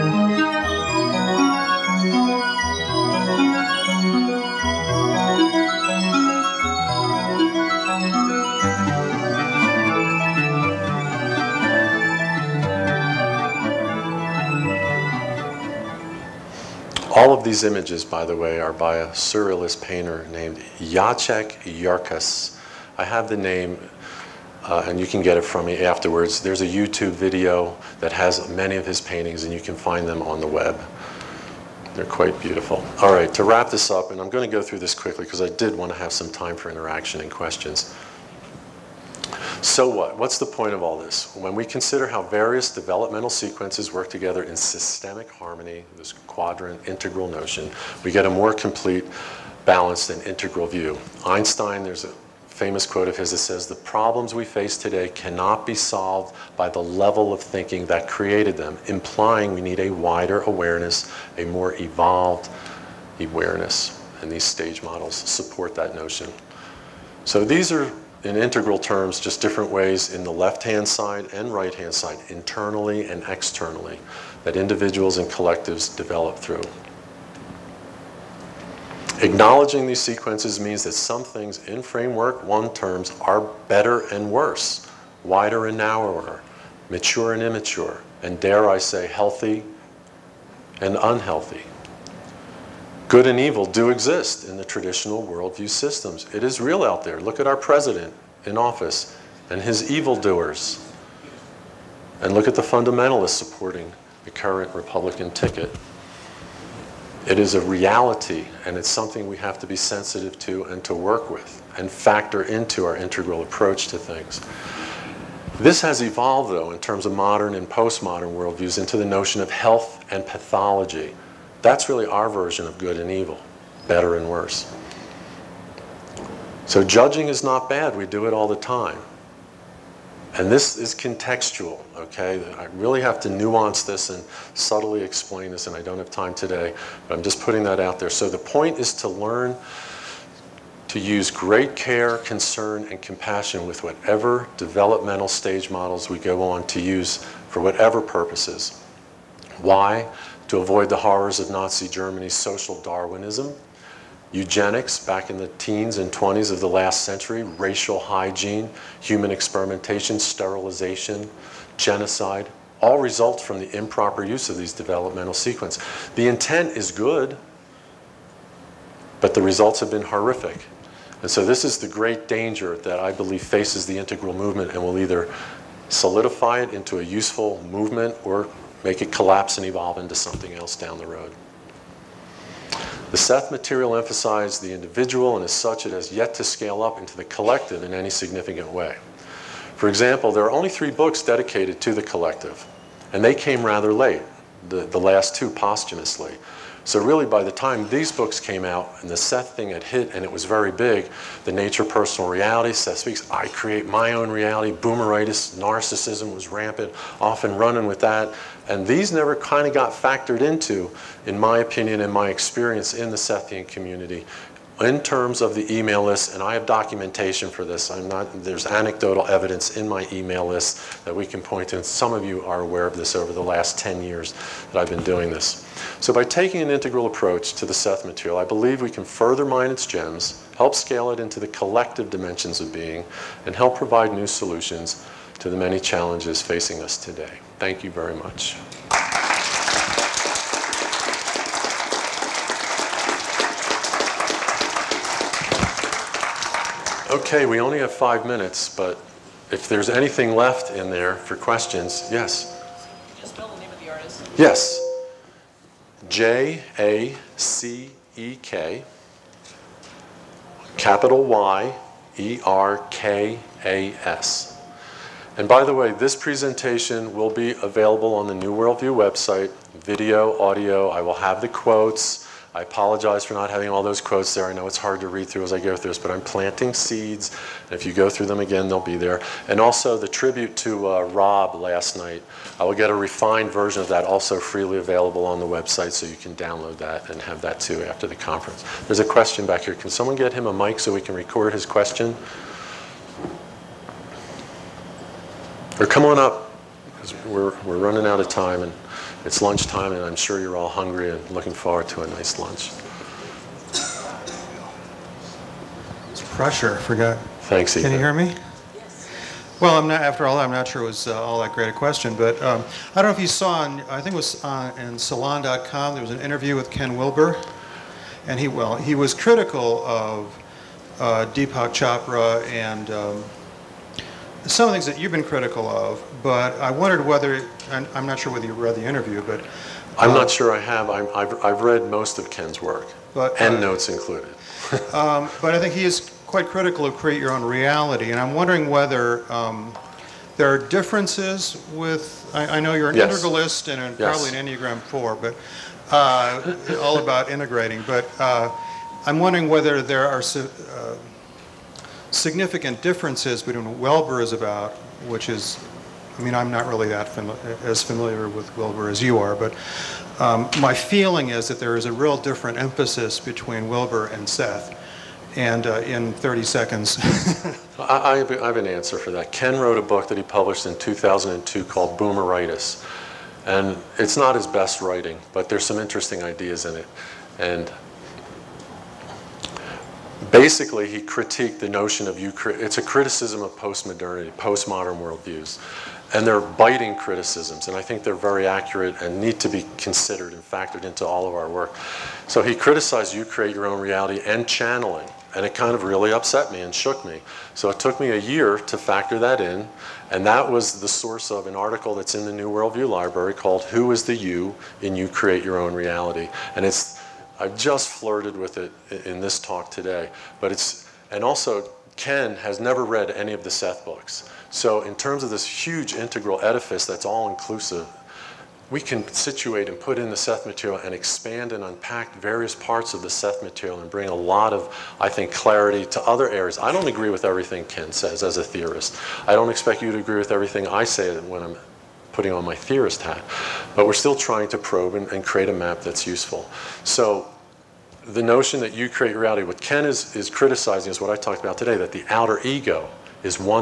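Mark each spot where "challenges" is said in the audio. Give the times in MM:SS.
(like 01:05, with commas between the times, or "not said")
03:55.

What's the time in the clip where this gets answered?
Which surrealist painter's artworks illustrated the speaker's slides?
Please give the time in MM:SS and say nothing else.
00:20.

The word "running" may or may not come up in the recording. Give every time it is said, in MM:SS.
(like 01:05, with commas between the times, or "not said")
03:27, 04:57.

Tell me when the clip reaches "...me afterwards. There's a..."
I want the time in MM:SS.
00:25.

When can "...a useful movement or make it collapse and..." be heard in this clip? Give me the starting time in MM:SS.
02:56.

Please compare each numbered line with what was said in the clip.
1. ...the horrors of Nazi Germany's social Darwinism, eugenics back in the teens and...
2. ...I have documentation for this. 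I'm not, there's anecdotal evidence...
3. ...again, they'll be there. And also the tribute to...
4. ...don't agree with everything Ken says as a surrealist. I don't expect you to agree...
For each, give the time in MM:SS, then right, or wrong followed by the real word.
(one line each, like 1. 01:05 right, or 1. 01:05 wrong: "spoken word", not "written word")
1. 02:30 right
2. 03:36 right
3. 04:38 right
4. 07:06 wrong: "theorist", not "surrealist".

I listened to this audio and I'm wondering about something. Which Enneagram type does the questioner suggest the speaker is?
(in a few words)
4.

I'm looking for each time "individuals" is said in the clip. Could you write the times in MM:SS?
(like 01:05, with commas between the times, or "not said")
01:14, 03:04.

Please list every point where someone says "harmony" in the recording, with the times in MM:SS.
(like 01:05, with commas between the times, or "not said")
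00:45.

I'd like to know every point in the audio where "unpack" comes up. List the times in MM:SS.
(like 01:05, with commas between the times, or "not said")
07:01.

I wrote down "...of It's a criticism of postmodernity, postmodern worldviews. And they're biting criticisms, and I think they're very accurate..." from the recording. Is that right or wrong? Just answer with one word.
right.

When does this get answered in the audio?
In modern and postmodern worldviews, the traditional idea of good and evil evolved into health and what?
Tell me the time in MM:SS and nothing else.
02:00.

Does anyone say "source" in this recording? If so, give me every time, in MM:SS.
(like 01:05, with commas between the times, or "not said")
06:40.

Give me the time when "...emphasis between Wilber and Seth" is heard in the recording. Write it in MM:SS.
06:02.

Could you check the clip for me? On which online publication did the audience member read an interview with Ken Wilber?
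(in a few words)
Salon.com.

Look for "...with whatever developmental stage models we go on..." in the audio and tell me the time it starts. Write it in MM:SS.
02:23.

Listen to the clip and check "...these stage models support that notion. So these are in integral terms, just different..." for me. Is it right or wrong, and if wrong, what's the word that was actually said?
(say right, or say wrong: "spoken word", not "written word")
right.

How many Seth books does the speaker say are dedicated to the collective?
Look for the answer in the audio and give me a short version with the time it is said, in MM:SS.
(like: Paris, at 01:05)
3, at 03:10.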